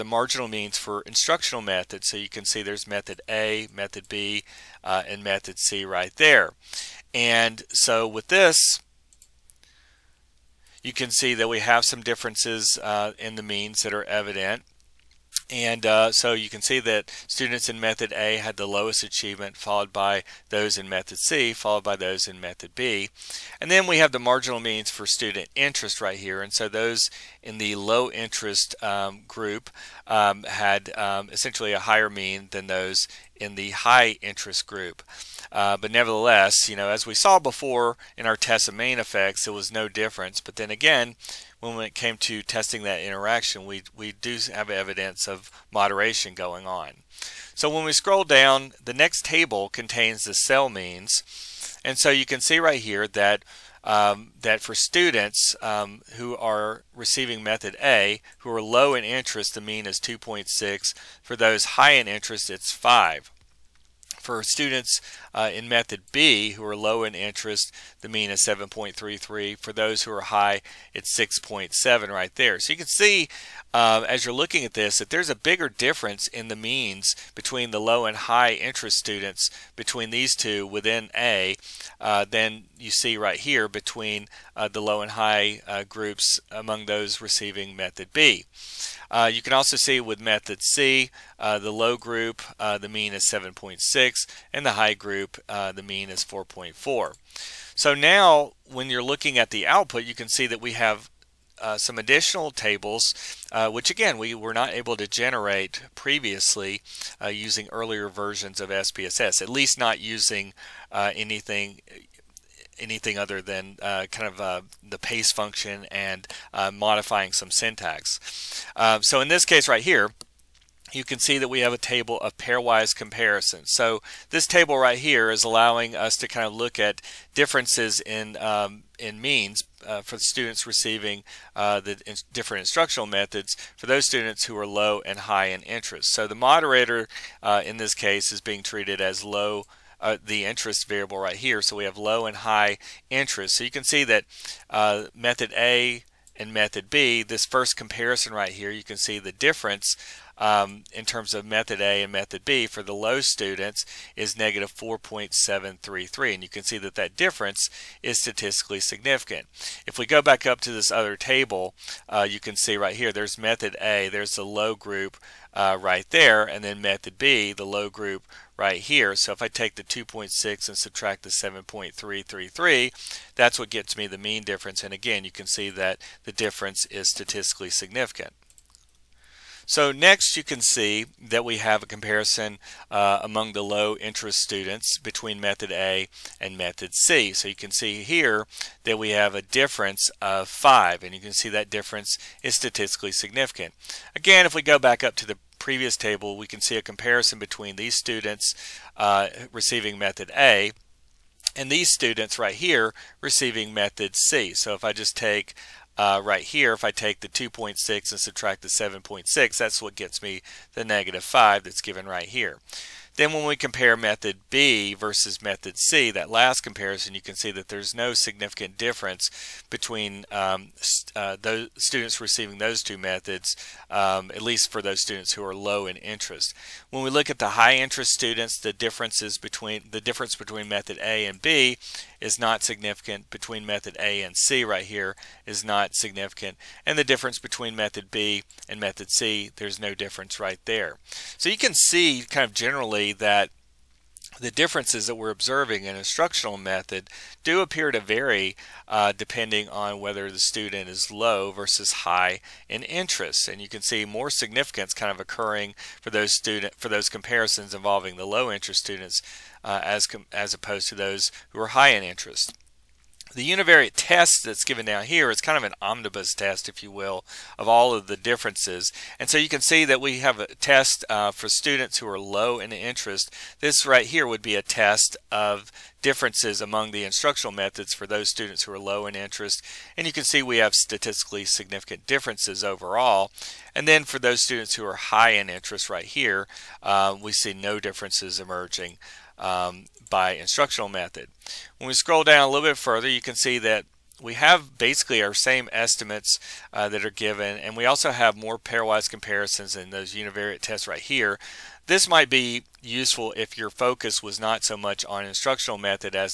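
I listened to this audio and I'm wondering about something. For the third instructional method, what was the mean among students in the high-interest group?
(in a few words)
4.4.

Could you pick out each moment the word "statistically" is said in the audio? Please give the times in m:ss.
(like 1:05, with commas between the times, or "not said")
2:38, 2:57, 3:12, 4:40.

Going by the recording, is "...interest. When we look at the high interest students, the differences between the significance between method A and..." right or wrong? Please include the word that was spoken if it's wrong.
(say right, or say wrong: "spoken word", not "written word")
wrong: "difference", not "significance".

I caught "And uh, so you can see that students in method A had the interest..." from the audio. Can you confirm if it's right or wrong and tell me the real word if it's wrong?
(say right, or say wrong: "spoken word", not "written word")
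wrong: "lowest", not "interest".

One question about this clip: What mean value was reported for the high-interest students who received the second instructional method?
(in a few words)
6.7.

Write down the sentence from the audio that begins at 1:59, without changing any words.
so in this case right here, you can see that we have a table of pairwise comparisons.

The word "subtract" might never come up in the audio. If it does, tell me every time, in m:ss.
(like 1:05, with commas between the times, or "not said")
2:50, 3:28.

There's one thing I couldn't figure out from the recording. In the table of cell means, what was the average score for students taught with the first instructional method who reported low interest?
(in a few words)
2.6.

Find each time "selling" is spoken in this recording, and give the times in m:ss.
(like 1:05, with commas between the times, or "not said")
not said.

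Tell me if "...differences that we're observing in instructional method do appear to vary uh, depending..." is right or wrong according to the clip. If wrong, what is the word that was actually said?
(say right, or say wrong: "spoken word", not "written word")
right.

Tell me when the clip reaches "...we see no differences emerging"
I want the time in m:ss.
4:47.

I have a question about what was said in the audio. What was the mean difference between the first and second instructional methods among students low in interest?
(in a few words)
-4.733.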